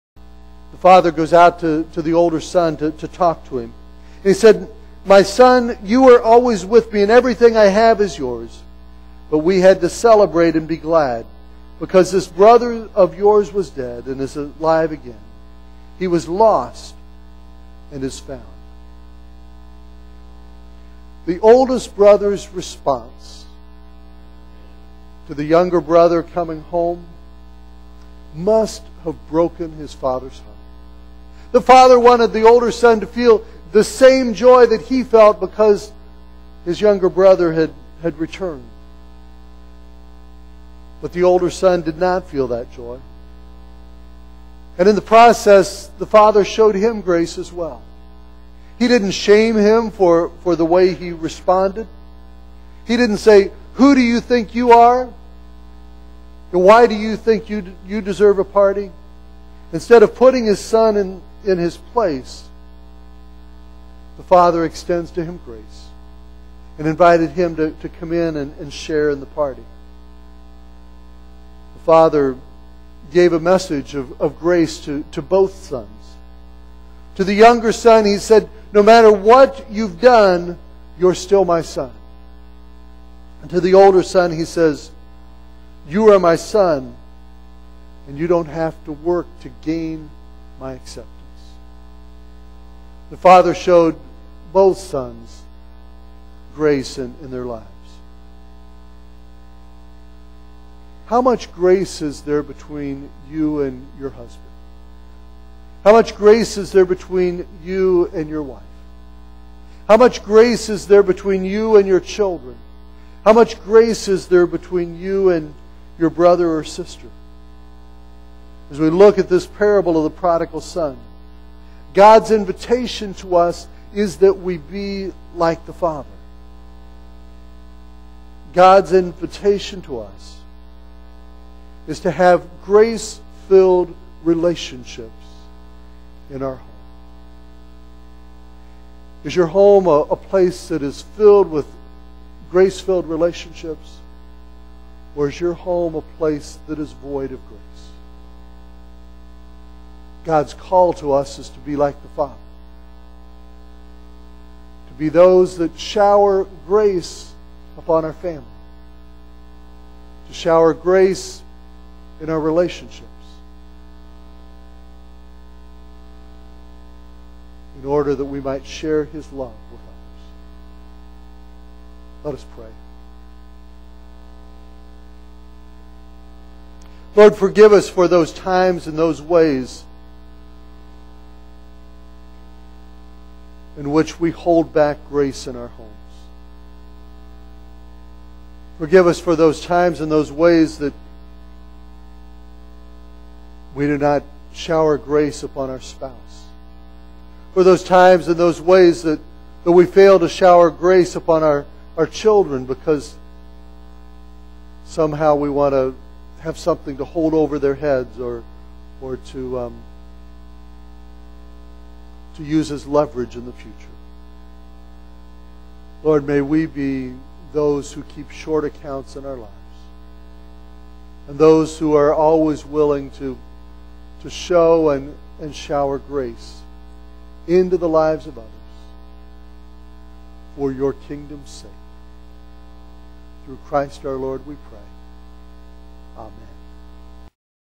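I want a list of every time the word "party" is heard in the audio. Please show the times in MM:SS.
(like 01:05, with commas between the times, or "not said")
00:58, 01:09.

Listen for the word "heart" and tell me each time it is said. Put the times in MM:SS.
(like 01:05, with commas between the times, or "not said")
00:30.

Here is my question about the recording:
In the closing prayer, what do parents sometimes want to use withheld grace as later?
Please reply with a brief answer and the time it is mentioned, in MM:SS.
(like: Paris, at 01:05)
leverage, at 03:32.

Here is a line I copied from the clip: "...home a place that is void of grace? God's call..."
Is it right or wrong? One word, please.
right.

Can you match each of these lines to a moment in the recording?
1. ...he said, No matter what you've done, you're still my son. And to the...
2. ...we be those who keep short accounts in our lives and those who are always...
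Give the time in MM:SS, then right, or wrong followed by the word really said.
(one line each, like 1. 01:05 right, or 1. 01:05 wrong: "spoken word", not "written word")
1. 01:18 right
2. 03:36 right.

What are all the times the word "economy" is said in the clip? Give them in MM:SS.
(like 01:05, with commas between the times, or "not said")
not said.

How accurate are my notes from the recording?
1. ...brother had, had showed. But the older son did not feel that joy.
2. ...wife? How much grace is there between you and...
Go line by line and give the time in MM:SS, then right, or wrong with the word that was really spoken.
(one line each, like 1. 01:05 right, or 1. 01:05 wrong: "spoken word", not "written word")
1. 00:37 wrong: "returned", not "showed"
2. 01:48 right.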